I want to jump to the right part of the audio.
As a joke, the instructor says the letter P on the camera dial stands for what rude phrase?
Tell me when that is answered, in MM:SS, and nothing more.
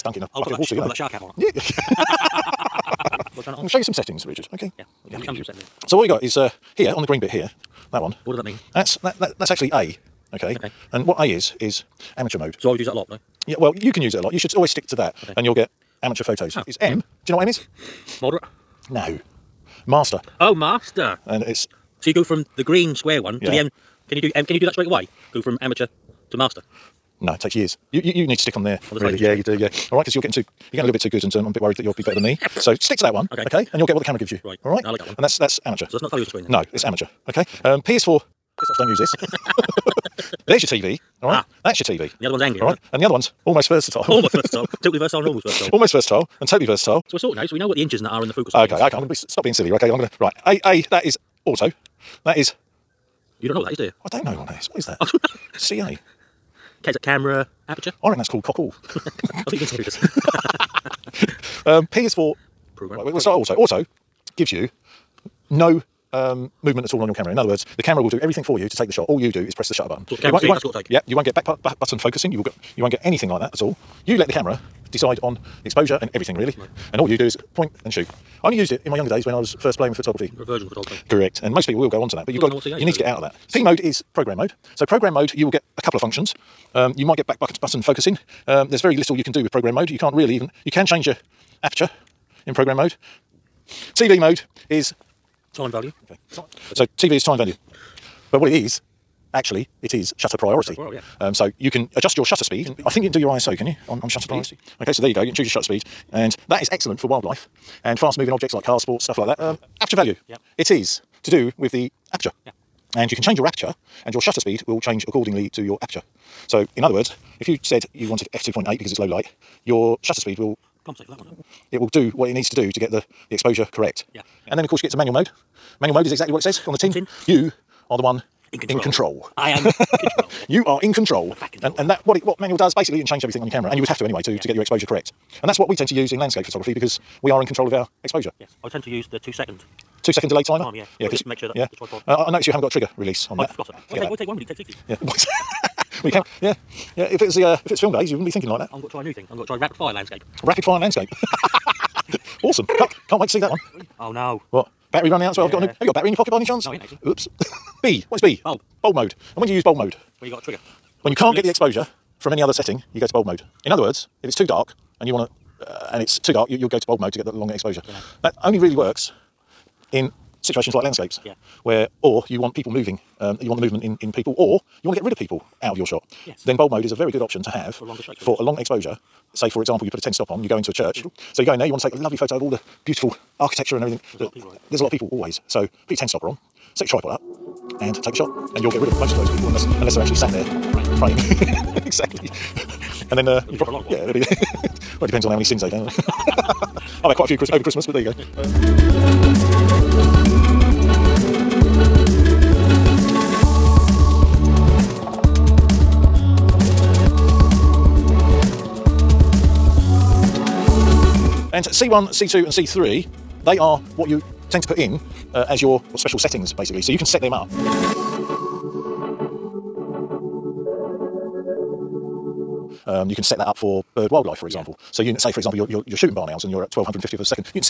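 00:38.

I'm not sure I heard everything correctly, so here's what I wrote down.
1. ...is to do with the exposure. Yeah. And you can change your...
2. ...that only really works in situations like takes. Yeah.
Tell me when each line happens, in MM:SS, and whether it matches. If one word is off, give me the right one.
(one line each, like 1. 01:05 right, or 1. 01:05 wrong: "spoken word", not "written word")
1. 01:50 wrong: "aperture", not "exposure"
2. 02:48 wrong: "landscapes", not "takes".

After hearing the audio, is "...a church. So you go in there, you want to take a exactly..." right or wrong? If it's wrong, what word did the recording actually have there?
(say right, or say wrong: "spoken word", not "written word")
wrong: "lovely", not "exactly".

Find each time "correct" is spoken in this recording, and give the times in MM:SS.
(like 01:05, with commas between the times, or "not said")
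01:21, 02:03, 02:14.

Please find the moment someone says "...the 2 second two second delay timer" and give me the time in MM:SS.
02:19.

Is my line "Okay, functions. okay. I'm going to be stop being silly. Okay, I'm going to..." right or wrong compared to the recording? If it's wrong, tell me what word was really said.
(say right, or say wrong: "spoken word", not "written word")
wrong: "means", not "functions".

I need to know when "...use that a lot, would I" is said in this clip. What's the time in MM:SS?
00:12.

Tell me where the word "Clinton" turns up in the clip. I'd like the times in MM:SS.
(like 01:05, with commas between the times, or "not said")
not said.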